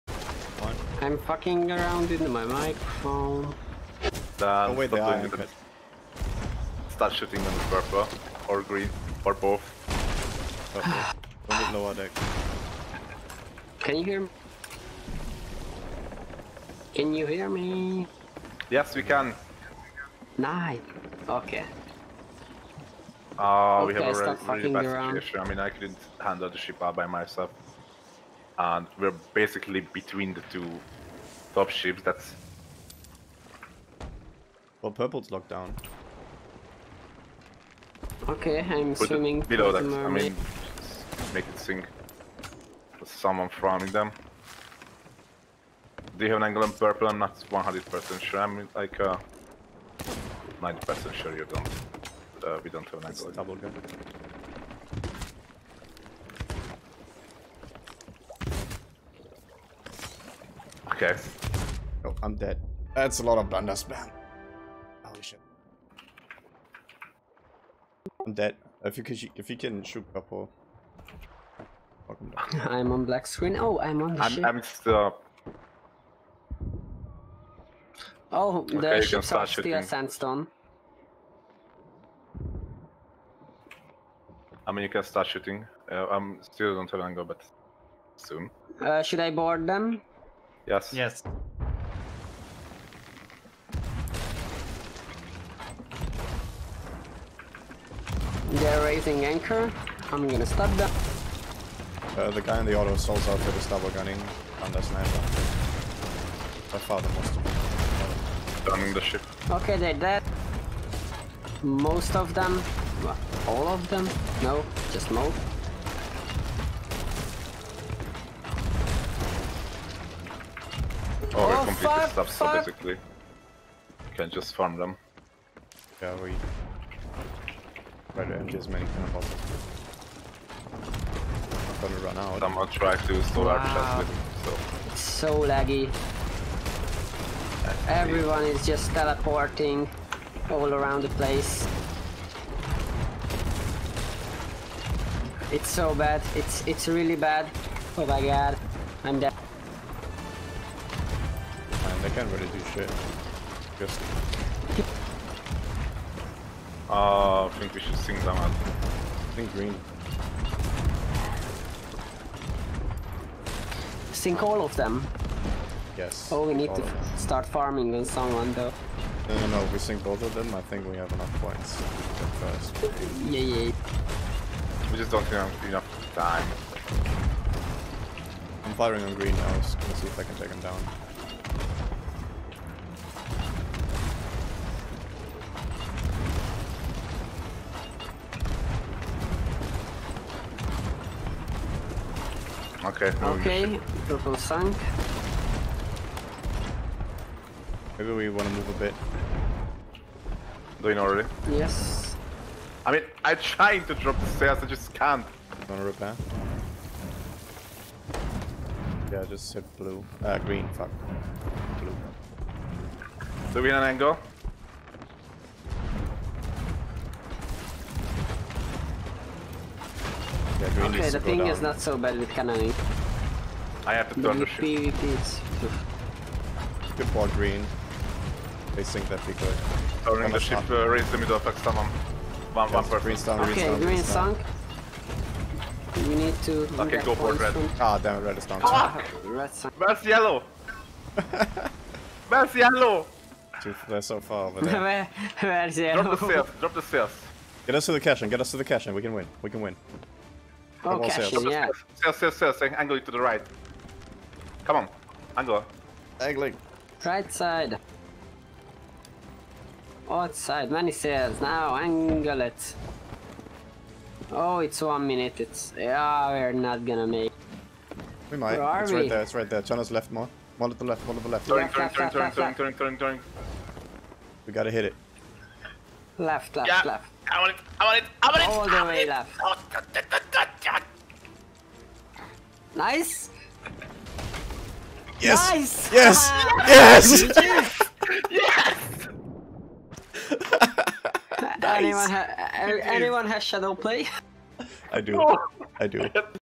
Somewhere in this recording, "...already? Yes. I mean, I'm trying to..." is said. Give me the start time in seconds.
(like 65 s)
200 s.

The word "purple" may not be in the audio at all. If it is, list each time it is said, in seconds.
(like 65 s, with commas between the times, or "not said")
7 s, 34 s, 46 s, 194 s.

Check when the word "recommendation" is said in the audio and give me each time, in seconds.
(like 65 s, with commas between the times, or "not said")
not said.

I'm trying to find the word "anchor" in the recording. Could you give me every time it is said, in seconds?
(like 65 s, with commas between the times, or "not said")
99 s.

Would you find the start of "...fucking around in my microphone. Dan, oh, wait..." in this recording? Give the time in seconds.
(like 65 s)
1 s.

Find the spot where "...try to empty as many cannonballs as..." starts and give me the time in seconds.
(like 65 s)
128 s.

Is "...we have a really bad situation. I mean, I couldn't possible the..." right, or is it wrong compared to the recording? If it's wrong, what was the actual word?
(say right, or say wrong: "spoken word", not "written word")
wrong: "handle", not "possible".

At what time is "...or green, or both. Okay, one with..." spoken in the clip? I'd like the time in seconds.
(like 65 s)
8 s.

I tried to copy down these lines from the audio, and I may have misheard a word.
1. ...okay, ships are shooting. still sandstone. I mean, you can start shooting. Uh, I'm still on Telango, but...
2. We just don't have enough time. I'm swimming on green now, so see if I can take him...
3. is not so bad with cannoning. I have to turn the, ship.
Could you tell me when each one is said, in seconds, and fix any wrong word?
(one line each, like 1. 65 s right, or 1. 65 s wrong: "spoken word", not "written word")
1. 78 s right
2. 174 s wrong: "firing", not "swimming"
3. 221 s right.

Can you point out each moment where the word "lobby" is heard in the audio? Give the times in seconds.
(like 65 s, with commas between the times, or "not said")
not said.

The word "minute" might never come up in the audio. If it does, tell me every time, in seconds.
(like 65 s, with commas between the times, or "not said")
265 s.